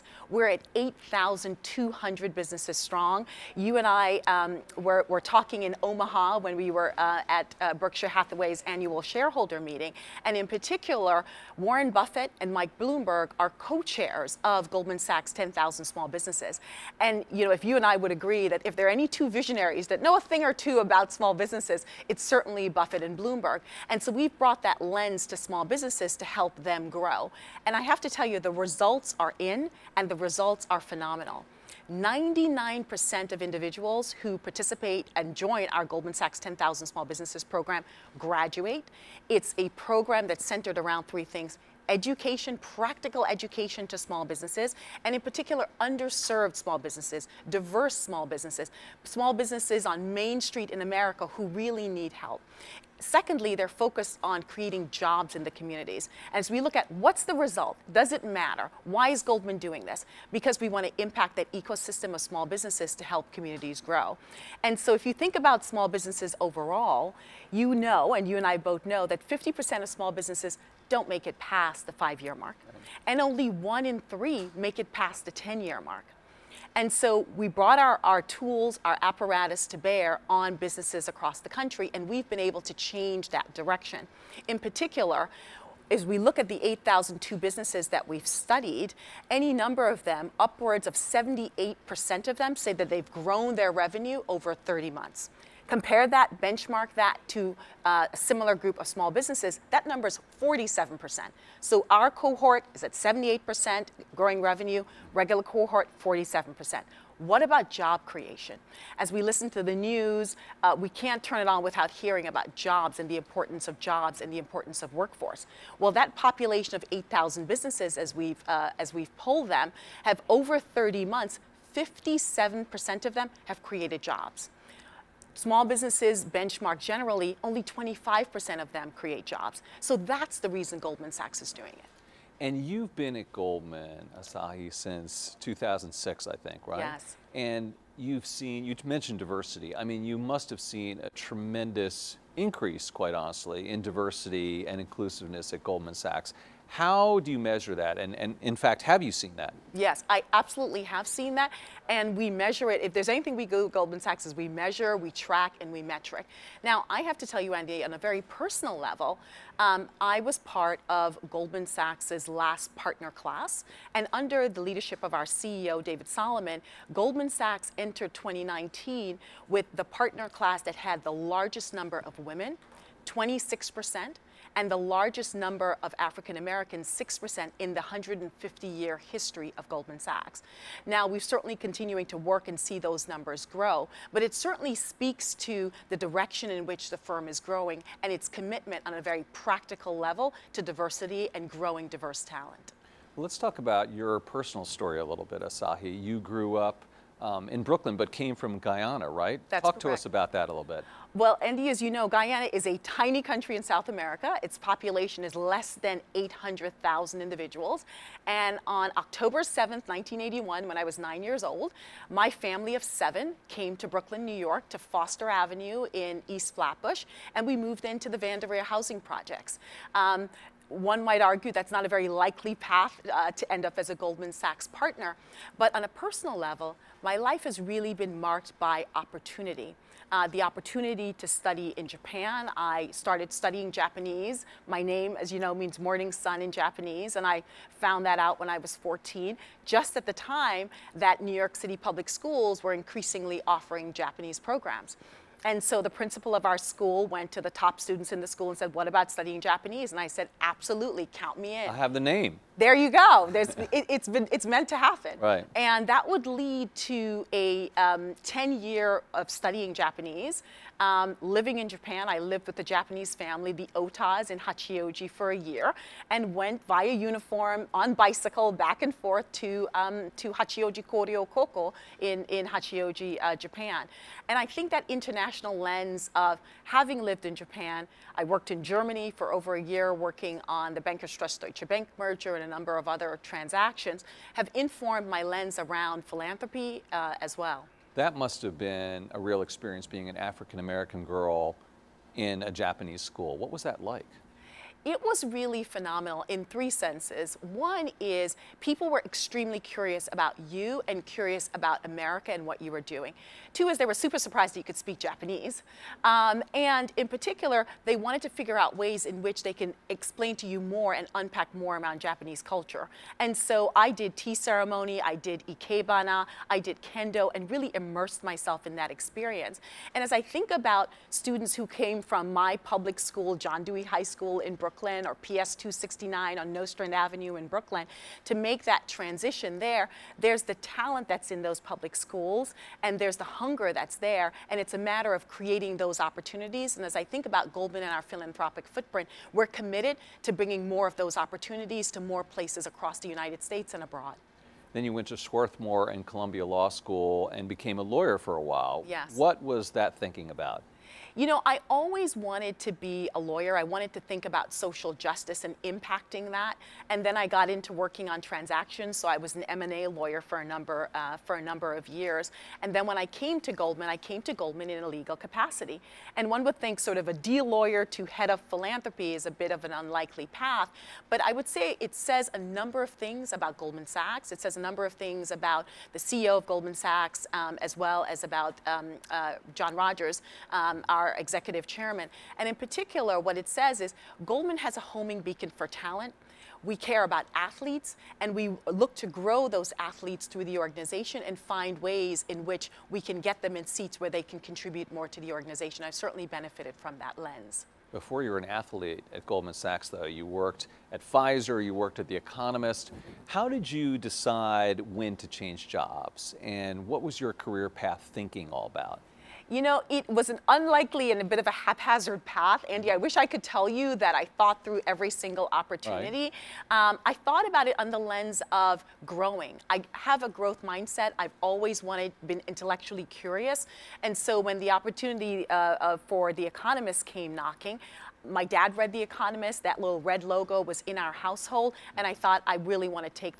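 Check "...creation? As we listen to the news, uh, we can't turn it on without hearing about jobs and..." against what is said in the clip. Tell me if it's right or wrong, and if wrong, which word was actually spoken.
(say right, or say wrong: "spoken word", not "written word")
right.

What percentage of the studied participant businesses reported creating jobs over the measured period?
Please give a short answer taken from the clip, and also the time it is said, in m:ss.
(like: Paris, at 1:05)
57%, at 2:01.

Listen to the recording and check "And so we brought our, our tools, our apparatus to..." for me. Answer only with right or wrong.
right.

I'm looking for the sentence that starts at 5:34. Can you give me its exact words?
And it's a matter of creating those opportunities.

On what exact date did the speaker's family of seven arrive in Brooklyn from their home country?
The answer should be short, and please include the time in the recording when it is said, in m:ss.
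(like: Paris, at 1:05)
October 7, 1981, at 3:28.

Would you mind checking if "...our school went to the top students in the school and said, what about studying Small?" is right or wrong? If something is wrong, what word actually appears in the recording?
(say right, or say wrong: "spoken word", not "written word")
wrong: "Japanese", not "Small".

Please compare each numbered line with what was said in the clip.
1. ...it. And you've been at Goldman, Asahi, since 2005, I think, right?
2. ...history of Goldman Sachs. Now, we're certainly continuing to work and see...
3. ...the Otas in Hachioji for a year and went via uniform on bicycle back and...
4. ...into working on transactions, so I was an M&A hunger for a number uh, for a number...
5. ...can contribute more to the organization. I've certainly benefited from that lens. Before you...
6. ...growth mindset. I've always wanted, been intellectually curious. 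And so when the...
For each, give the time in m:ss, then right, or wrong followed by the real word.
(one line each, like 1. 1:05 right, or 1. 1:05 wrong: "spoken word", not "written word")
1. 2:11 wrong: "2006", not "2005"
2. 2:59 right
3. 4:23 right
4. 5:57 wrong: "lawyer", not "hunger"
5. 6:34 right
6. 7:00 right.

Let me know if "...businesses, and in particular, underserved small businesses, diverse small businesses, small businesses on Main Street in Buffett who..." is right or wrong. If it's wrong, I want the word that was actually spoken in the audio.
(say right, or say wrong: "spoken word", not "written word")
wrong: "America", not "Buffett".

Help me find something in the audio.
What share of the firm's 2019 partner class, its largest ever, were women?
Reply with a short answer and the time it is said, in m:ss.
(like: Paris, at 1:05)
26%, at 2:53.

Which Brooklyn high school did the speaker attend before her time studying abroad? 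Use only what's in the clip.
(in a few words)
John Dewey High School.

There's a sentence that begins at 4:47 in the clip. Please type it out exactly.
That must have been a real experience being an African American girl in a Japanese school.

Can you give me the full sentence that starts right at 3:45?
But on a personal level, my life has really been marked by opportunity.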